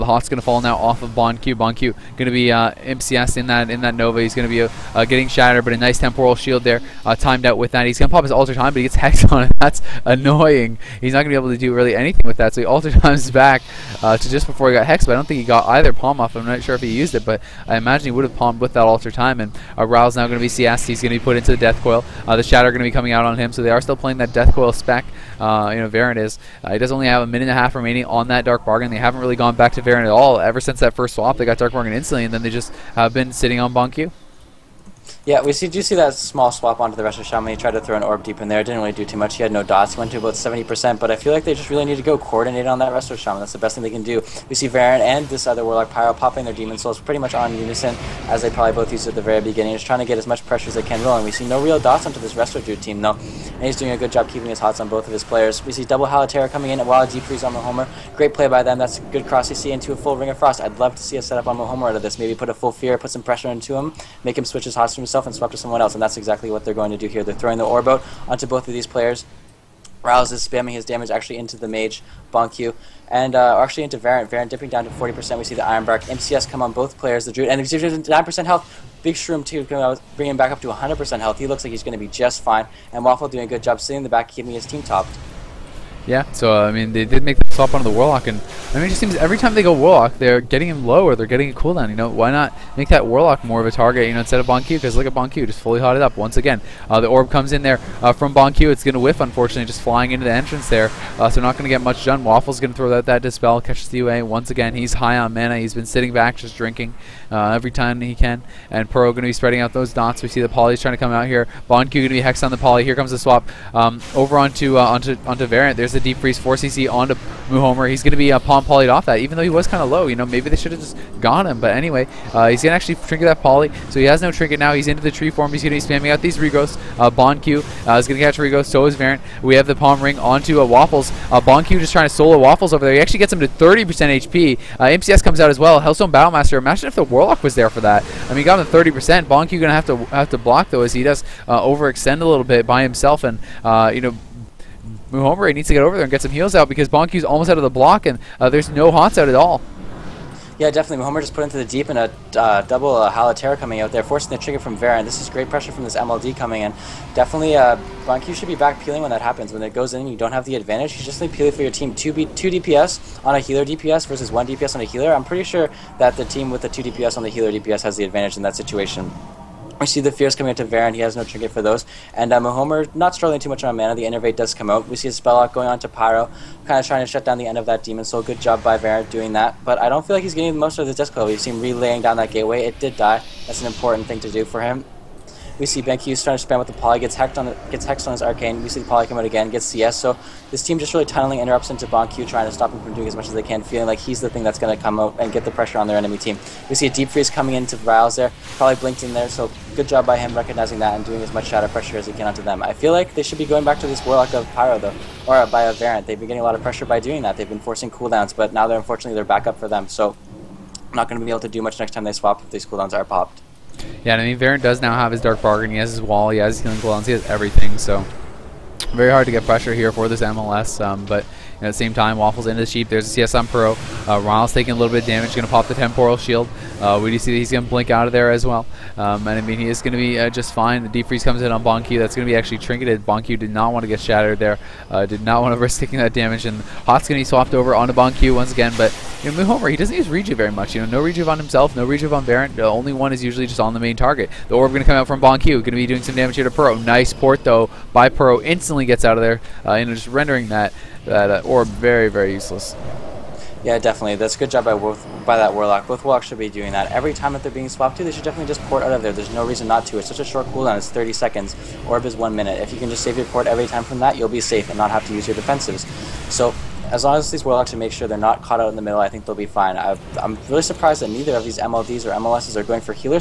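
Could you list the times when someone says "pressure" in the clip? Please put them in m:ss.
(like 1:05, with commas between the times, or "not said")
0:50, 1:03, 2:35, 3:15, 3:21, 3:26, 3:39.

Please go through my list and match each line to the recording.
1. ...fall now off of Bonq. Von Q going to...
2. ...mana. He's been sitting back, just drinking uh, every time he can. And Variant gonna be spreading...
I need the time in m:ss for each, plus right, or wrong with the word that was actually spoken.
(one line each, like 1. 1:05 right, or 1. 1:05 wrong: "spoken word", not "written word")
1. 0:00 right
2. 1:45 wrong: "Pro", not "Variant".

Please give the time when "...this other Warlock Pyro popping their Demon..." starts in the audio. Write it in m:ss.
0:45.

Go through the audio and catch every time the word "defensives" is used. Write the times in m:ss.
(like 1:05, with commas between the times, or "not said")
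4:25.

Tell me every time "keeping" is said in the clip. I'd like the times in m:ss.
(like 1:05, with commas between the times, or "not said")
0:54, 1:24.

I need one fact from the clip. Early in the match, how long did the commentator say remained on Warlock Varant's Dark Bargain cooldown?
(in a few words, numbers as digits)
a minute and a half.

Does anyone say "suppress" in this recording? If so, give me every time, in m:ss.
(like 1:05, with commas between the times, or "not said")
not said.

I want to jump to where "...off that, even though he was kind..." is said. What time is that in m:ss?
1:58.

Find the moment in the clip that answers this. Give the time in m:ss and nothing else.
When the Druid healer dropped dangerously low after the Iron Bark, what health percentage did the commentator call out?
1:18.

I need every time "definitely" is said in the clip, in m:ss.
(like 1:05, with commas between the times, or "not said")
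2:30, 2:37, 4:13, 4:18.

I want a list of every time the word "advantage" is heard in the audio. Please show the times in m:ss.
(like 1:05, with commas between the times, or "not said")
2:40, 2:48.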